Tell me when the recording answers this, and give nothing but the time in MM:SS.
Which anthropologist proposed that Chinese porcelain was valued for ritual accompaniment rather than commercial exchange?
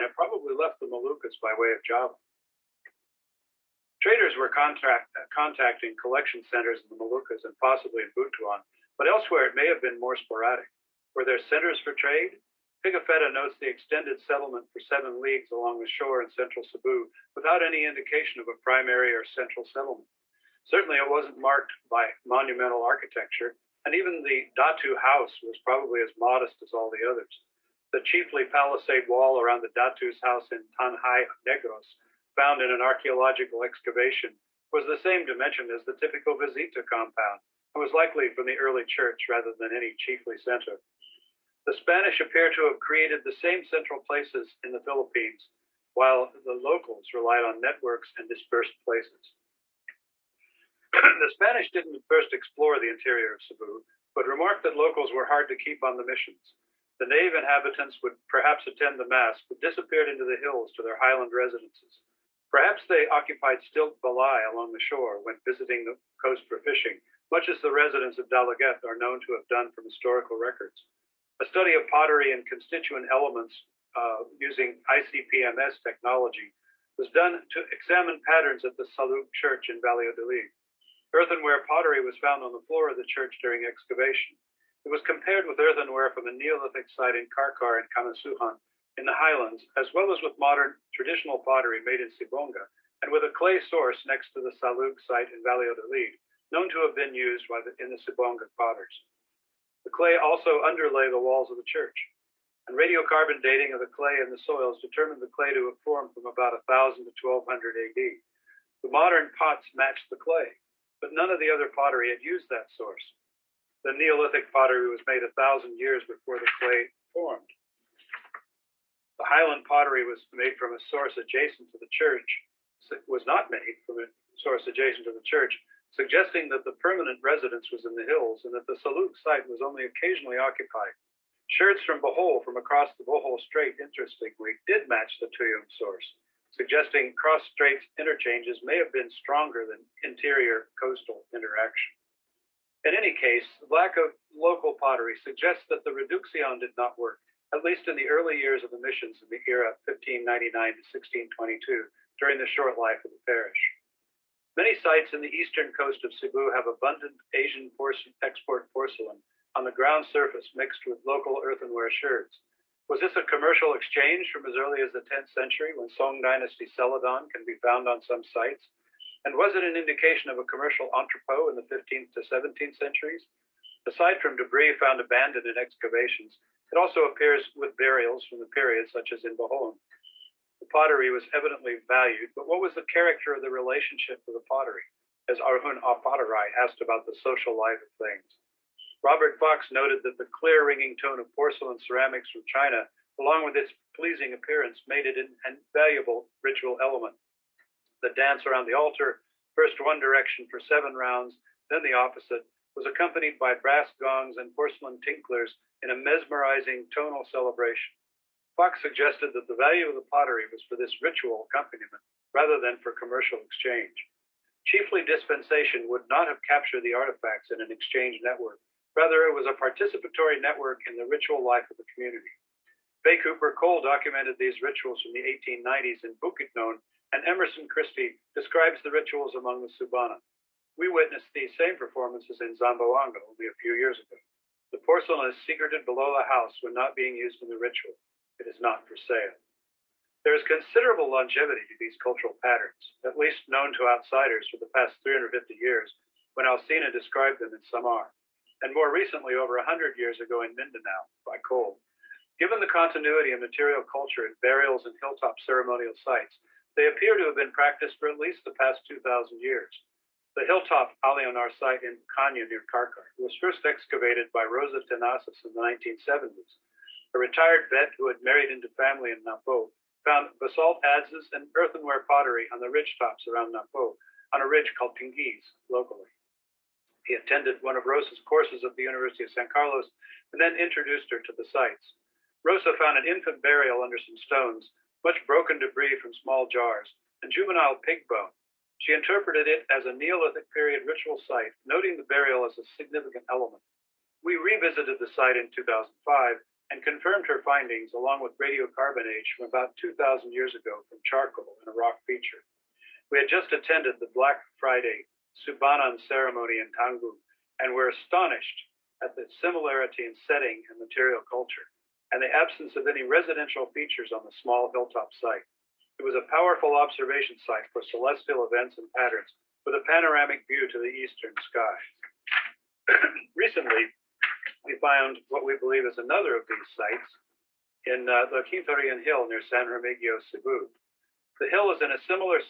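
03:09.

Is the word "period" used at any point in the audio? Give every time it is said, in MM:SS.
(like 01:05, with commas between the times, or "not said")
02:58, 04:50.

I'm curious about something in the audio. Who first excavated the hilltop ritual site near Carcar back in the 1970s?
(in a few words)
Rosa Tenazas.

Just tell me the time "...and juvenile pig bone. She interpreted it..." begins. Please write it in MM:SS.
04:47.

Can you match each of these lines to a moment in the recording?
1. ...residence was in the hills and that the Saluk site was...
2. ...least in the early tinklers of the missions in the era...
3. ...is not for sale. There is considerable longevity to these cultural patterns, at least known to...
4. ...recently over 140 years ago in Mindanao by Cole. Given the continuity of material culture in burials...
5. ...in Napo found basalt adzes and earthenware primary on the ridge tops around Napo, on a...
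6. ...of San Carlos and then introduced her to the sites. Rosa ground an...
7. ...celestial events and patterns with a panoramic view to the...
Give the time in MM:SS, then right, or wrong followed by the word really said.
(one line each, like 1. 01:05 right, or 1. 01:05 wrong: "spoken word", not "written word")
1. 02:07 right
2. 02:27 wrong: "years", not "tinklers"
3. 03:58 right
4. 04:08 wrong: "100", not "140"
5. 04:29 wrong: "pottery", not "primary"
6. 04:39 wrong: "found", not "ground"
7. 05:17 right.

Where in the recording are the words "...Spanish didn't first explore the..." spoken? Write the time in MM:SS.
00:51.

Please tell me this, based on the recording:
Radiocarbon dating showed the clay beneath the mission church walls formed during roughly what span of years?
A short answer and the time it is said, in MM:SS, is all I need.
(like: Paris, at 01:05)
1000 to 1200 AD, at 01:46.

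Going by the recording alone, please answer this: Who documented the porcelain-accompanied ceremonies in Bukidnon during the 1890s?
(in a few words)
Fay Cooper Cole.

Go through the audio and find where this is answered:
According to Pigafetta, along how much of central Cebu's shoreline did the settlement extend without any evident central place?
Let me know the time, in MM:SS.
00:14.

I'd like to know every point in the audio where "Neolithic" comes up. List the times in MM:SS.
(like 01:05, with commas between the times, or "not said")
01:26, 01:53, 04:49.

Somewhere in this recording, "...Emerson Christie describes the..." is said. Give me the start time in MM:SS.
03:47.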